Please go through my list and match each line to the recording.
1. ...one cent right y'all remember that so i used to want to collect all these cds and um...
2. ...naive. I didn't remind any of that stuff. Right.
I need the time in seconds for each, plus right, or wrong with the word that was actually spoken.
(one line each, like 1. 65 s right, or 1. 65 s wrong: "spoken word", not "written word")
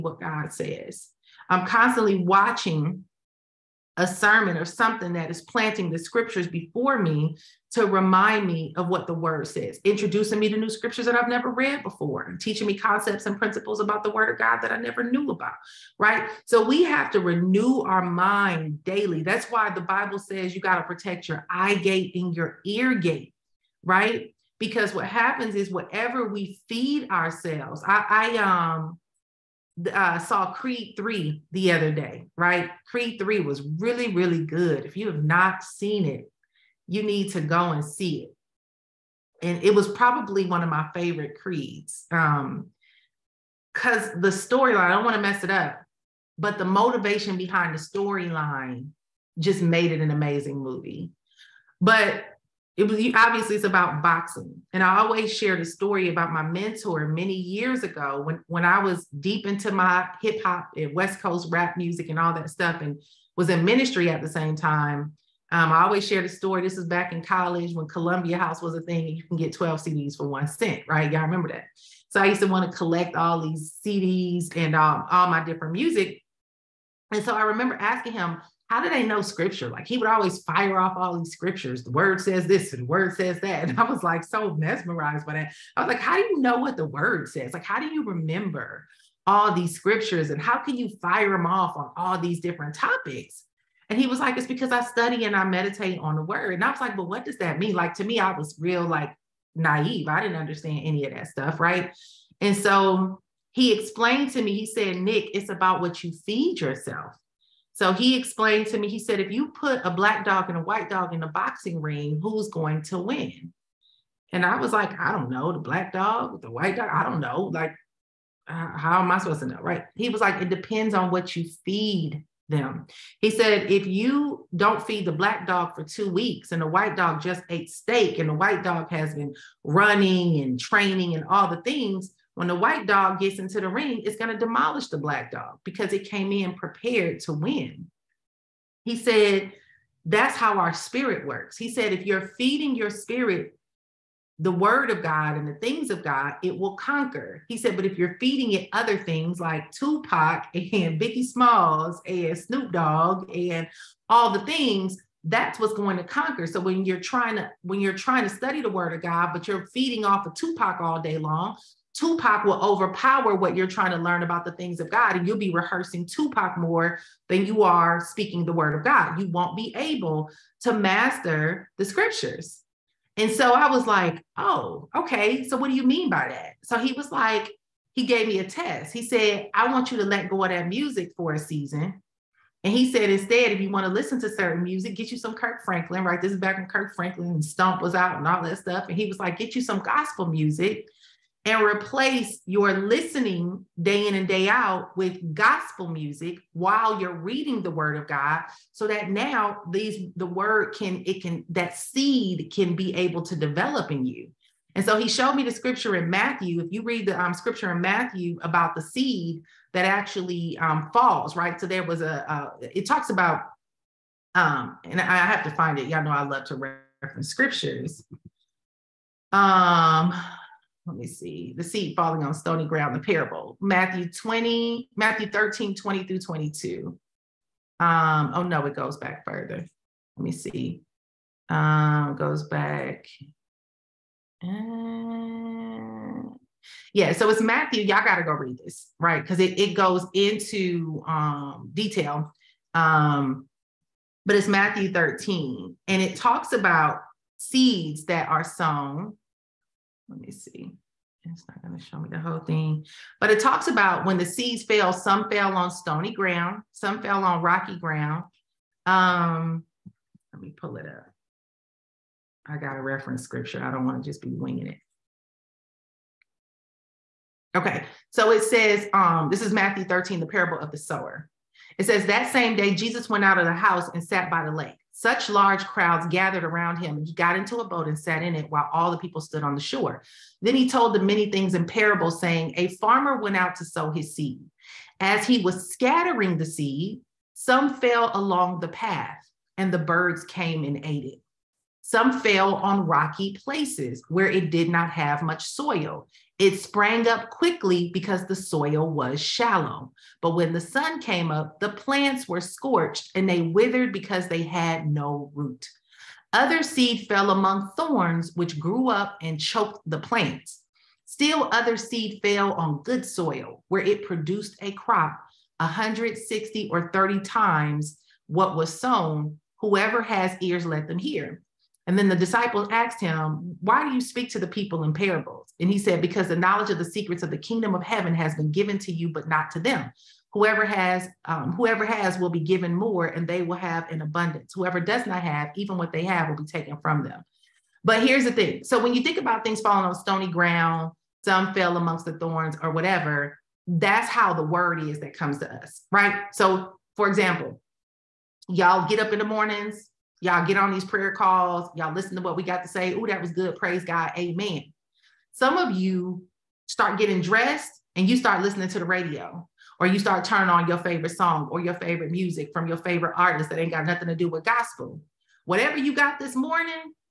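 1. 70 s right
2. 99 s wrong: "understand", not "remind".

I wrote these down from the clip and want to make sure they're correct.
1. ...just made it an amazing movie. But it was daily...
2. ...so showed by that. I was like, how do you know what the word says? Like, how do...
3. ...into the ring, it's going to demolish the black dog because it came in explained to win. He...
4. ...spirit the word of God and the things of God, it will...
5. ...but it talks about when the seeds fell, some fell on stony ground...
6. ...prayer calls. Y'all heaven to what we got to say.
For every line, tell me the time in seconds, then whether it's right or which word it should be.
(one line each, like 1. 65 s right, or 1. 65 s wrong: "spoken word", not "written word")
1. 49 s wrong: "obviously", not "daily"
2. 84 s wrong: "mesmerized", not "showed"
3. 133 s wrong: "prepared", not "explained"
4. 142 s right
5. 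253 s right
6. 350 s wrong: "listen", not "heaven".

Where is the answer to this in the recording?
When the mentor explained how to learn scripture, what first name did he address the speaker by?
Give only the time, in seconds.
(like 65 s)
104 s.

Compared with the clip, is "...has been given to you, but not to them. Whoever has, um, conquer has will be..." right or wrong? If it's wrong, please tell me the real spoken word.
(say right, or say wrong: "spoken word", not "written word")
wrong: "whoever", not "conquer".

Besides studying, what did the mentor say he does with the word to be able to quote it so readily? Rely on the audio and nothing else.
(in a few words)
Meditate.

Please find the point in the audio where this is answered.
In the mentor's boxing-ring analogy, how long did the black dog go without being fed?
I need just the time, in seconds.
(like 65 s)
125 s.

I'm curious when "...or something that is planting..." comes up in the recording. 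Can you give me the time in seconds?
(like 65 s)
4 s.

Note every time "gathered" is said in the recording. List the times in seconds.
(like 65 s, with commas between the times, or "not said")
276 s.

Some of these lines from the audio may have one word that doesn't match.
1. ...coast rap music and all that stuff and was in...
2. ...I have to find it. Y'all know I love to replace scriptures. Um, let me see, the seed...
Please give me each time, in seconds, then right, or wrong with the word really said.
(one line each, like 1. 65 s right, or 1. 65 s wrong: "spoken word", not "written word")
1. 61 s right
2. 214 s wrong: "reference", not "replace".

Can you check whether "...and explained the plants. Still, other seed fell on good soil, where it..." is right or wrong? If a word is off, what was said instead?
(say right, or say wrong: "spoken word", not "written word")
wrong: "choked", not "explained".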